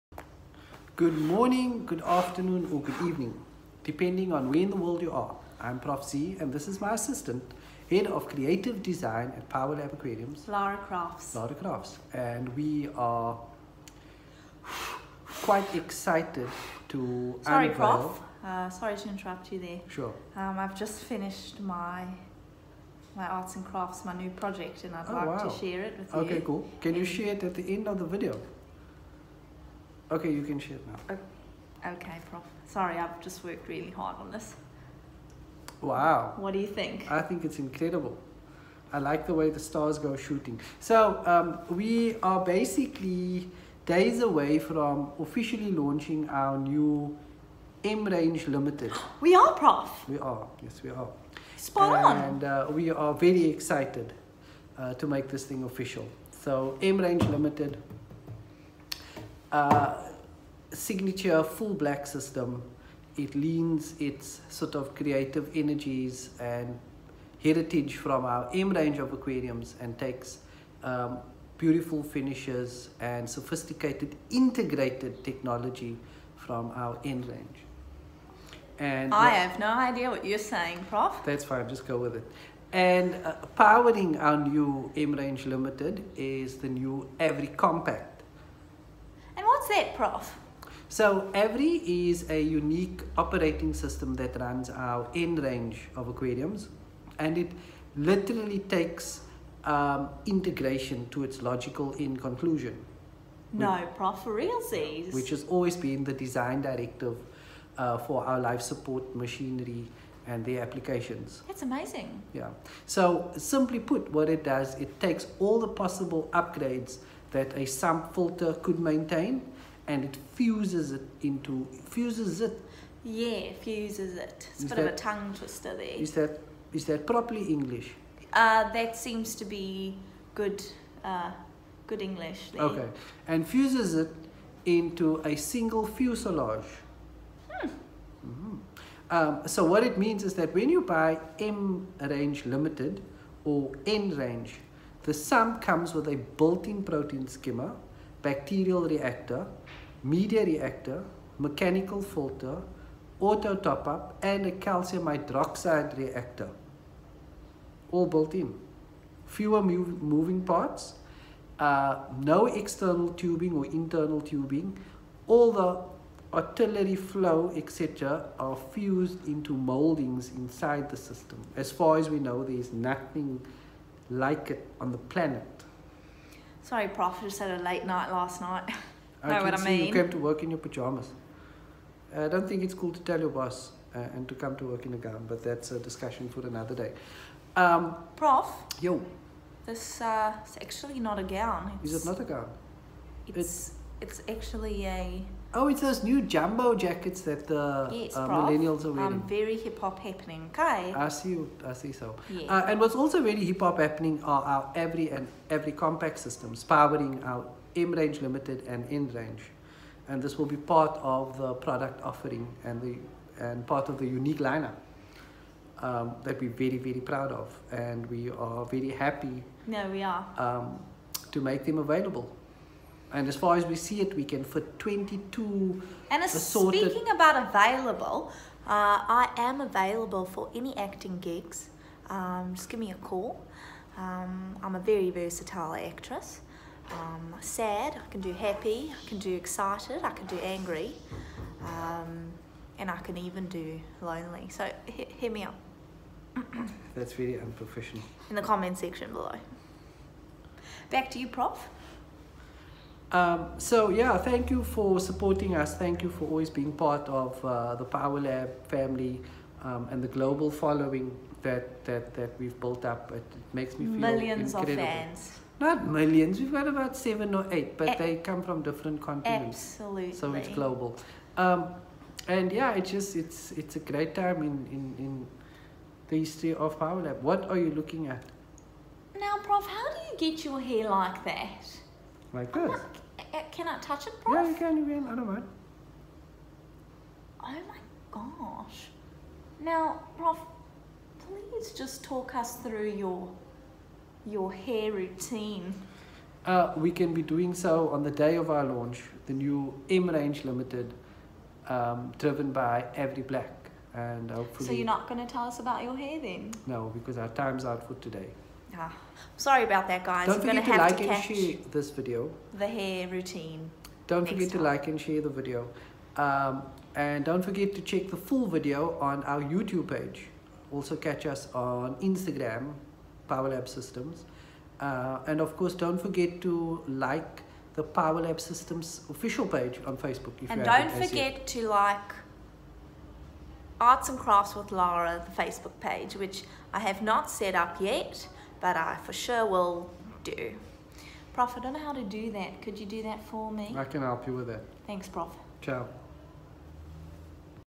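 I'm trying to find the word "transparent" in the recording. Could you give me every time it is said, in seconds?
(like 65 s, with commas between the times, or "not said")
not said.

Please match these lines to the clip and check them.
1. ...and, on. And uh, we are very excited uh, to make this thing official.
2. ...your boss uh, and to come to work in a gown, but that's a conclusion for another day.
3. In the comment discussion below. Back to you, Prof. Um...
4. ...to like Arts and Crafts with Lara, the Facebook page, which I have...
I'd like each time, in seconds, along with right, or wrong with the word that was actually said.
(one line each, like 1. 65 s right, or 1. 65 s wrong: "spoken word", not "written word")
1. 51 s right
2. 183 s wrong: "discussion", not "conclusion"
3. 248 s wrong: "section", not "discussion"
4. 331 s right.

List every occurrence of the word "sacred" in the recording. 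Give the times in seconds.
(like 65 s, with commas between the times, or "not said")
not said.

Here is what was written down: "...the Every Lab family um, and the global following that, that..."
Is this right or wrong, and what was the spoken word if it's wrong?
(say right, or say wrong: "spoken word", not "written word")
wrong: "Power", not "Every".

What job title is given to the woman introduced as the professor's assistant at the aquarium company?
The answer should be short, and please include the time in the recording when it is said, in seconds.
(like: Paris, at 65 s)
Head of Creative Design, at 7 s.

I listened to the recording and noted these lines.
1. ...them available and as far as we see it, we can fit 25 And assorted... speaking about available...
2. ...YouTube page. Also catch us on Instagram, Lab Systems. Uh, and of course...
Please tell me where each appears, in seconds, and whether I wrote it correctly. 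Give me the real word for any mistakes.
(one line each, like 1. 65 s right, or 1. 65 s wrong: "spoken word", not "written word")
1. 221 s wrong: "22", not "25"
2. 319 s wrong: "PowerLab", not "Lab".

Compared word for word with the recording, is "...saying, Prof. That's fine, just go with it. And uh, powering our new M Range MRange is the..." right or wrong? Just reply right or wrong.
wrong.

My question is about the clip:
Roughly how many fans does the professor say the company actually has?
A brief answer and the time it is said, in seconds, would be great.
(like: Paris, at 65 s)
about seven or eight, at 266 s.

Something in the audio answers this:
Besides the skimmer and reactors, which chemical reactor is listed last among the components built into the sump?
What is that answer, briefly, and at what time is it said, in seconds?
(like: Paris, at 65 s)
calcium hydroxide reactor, at 154 s.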